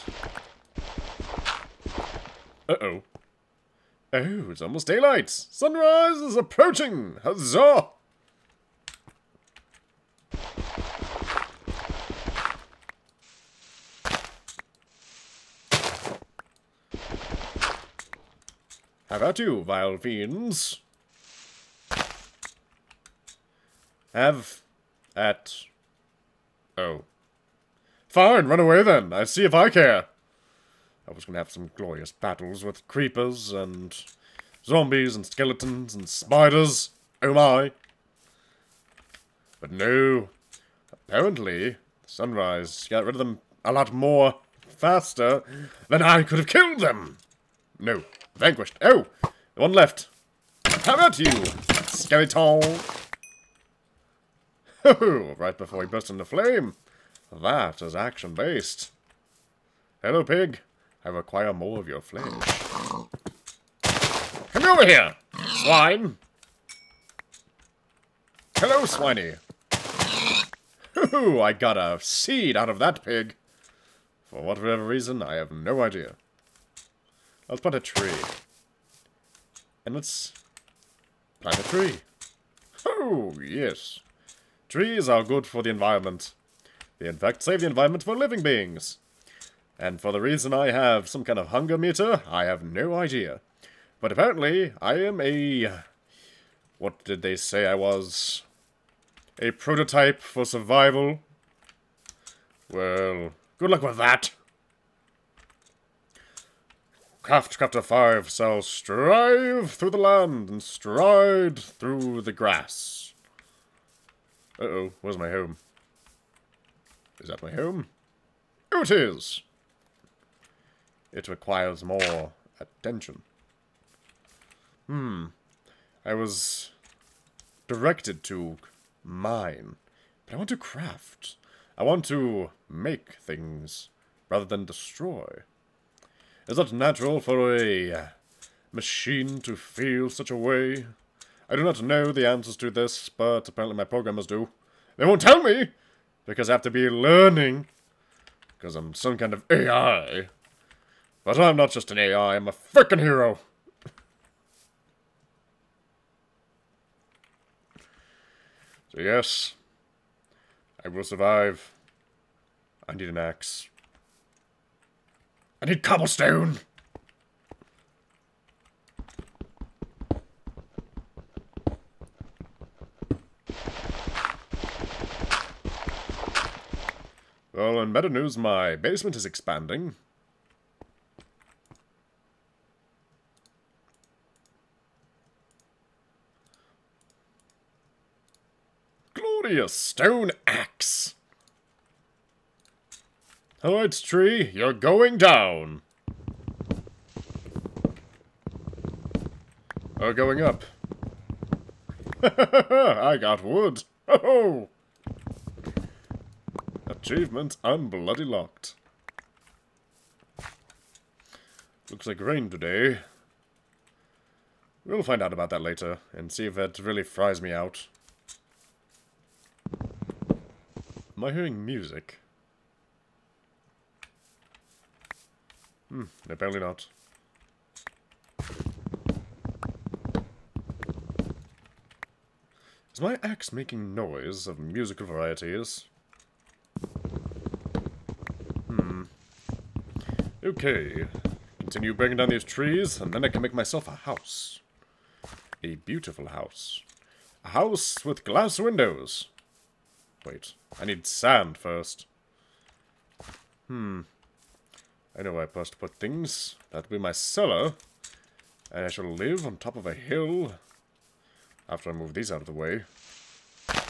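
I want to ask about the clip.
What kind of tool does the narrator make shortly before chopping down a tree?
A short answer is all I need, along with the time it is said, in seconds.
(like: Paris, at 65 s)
Stone axe, at 189 s.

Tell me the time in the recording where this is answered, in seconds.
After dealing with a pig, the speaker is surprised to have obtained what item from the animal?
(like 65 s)
71 s.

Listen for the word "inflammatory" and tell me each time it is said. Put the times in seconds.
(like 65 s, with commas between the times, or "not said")
not said.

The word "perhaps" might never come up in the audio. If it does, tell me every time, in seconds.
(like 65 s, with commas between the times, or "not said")
not said.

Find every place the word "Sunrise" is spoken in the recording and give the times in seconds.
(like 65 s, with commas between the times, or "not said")
5 s, 42 s.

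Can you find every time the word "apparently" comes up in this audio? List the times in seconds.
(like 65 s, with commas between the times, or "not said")
40 s, 94 s, 143 s, 226 s.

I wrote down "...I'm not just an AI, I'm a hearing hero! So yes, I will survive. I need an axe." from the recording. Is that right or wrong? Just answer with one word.
wrong.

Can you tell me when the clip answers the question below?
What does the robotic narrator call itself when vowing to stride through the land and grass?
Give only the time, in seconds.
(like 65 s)
107 s.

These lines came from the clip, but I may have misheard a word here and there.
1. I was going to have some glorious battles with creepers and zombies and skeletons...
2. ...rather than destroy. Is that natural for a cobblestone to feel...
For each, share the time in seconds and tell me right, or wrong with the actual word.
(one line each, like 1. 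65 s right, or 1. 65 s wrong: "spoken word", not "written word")
1. 31 s right
2. 134 s wrong: "machine", not "cobblestone".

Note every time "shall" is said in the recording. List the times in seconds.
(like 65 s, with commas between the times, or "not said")
108 s, 258 s.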